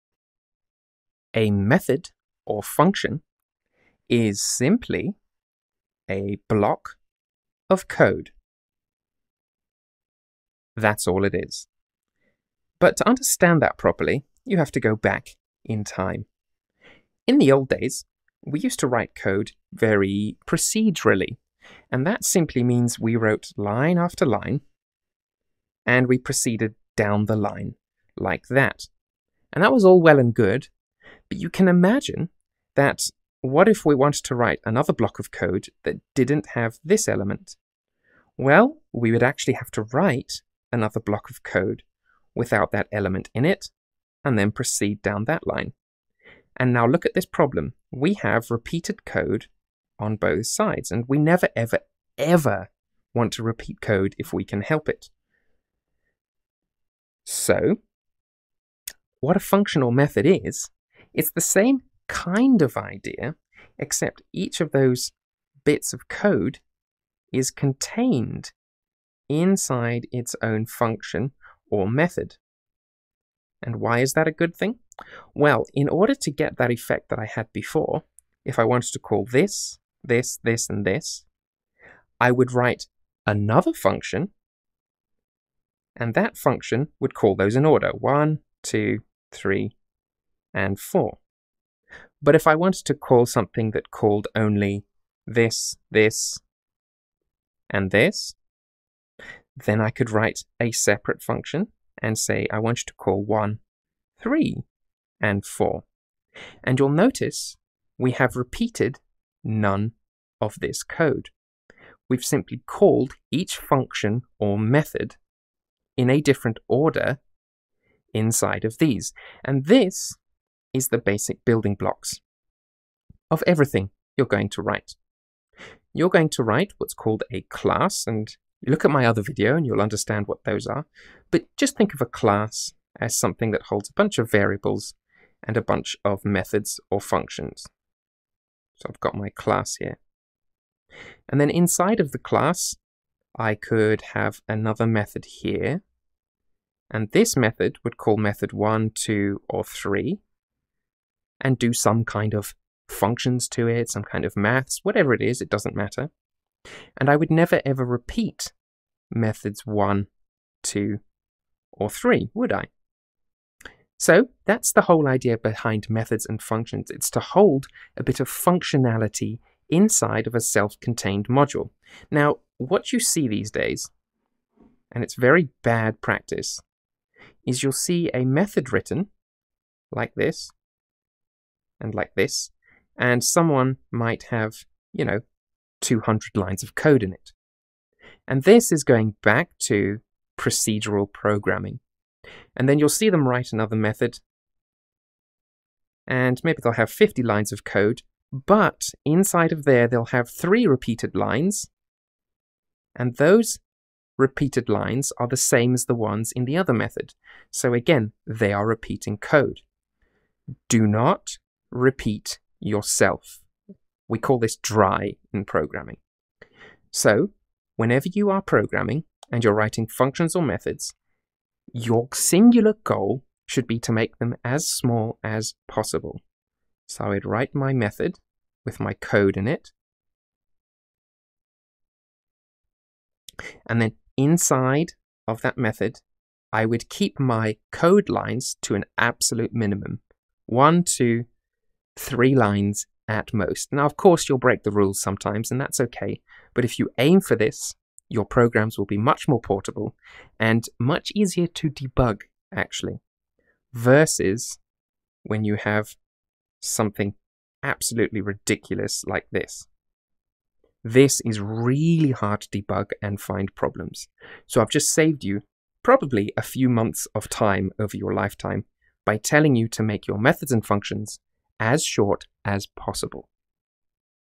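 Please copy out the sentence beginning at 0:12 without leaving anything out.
But to understand that properly, you have to go back in time.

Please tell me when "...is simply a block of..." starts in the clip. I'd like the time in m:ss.
0:04.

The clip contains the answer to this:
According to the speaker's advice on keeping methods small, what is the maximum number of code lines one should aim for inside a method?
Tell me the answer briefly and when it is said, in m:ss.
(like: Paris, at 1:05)
3, at 4:02.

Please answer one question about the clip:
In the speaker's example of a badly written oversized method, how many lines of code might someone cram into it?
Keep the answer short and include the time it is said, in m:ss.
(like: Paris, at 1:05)
200, at 3:05.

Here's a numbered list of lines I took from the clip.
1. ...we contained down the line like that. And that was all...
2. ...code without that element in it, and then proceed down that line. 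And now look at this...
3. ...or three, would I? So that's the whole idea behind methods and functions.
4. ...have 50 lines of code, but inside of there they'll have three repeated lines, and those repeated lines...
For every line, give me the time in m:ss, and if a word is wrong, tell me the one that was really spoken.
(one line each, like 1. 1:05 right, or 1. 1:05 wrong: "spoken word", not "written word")
1. 0:26 wrong: "proceeded", not "contained"
2. 0:41 right
3. 2:41 right
4. 3:16 right.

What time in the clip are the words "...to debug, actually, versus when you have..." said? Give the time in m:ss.
4:11.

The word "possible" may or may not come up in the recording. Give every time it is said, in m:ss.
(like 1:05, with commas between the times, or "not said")
3:45, 4:32.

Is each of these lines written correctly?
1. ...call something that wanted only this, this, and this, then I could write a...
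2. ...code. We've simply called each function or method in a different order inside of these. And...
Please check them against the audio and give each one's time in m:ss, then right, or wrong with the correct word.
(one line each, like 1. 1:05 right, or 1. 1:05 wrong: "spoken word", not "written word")
1. 1:32 wrong: "called", not "wanted"
2. 1:50 right.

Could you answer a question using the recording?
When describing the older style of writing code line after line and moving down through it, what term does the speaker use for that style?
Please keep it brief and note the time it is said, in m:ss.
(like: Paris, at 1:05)
procedurally, at 0:20.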